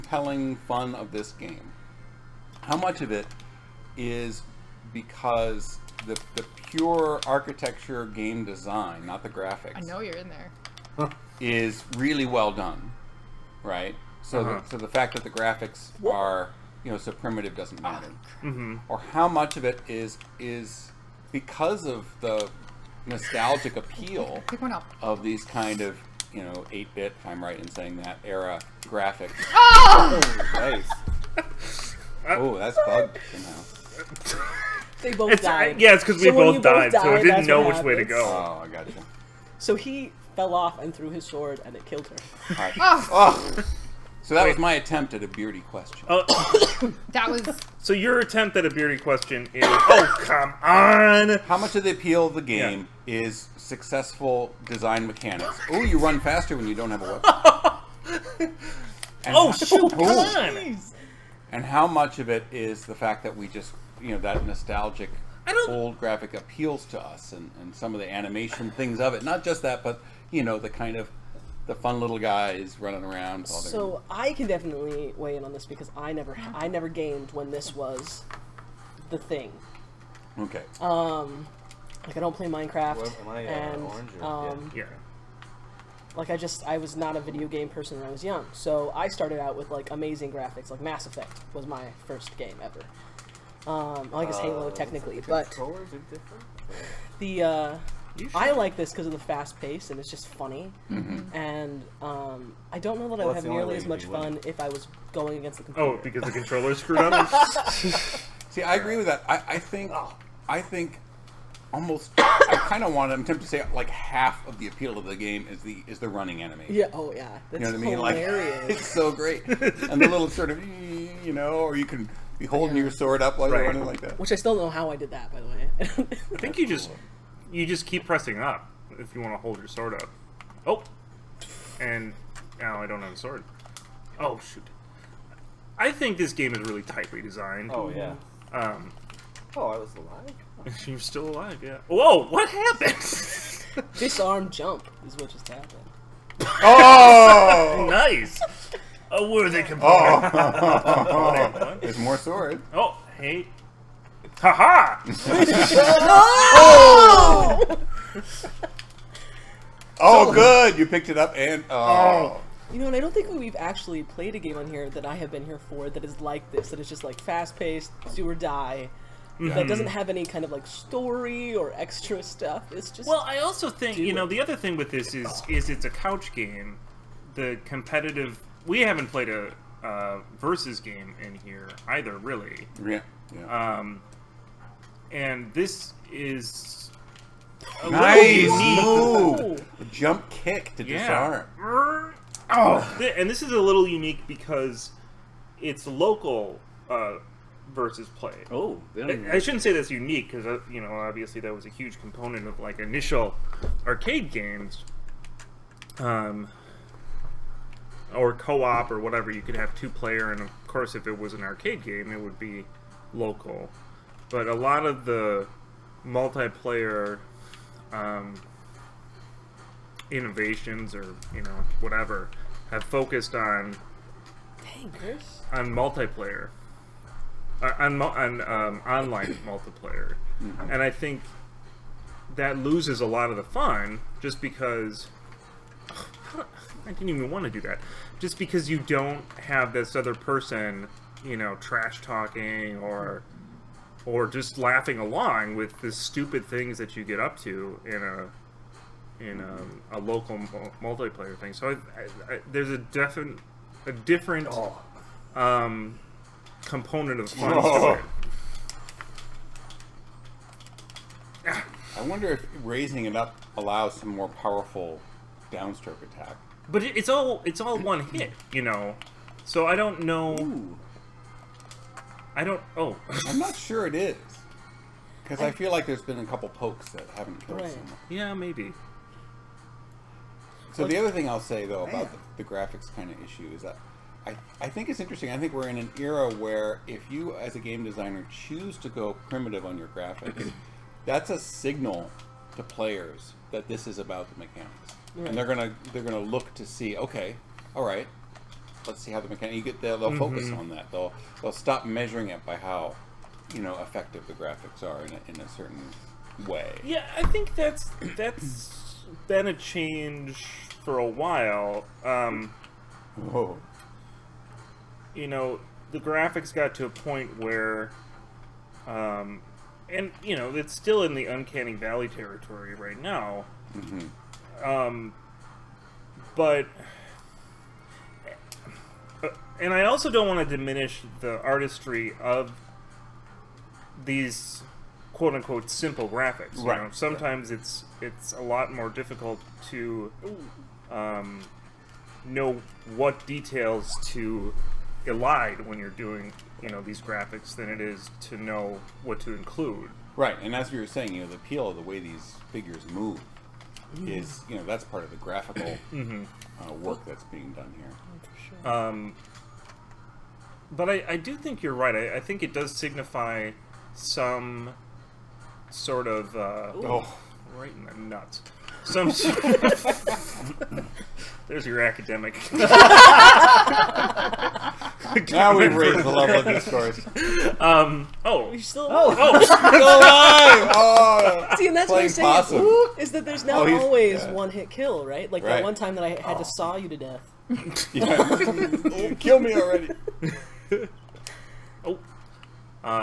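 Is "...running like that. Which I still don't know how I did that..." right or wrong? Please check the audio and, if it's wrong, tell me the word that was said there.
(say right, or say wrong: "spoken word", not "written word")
right.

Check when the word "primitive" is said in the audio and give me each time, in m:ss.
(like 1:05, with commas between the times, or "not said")
0:17, 4:49.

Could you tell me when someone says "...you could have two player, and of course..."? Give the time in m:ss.
3:29.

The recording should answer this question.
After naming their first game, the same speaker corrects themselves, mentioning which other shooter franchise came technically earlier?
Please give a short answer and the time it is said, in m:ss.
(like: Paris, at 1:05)
Halo, at 1:34.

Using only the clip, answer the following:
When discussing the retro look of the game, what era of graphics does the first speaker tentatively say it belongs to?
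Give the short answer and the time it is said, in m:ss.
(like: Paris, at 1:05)
8-bit, at 0:26.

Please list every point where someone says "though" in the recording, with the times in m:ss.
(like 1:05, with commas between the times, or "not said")
4:41.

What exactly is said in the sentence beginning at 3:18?
Oh, I, I, shouldn't say that's unique because uh, you know obviously that was a huge component of like initial arcade games.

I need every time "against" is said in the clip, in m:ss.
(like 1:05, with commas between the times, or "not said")
1:45.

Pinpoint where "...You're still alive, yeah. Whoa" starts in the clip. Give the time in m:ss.
2:20.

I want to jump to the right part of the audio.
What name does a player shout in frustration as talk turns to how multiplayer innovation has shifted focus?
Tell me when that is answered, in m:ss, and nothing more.
3:44.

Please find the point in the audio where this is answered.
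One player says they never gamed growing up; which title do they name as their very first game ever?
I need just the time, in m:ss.
1:30.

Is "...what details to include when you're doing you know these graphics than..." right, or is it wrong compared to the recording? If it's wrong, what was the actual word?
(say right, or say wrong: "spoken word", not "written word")
wrong: "elide", not "include".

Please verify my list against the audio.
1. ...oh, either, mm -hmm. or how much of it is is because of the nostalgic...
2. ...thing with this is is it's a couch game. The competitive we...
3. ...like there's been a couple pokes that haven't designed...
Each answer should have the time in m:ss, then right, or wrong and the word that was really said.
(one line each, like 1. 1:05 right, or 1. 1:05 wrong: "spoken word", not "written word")
1. 0:17 wrong: "matter", not "either"
2. 2:54 right
3. 4:35 wrong: "killed", not "designed".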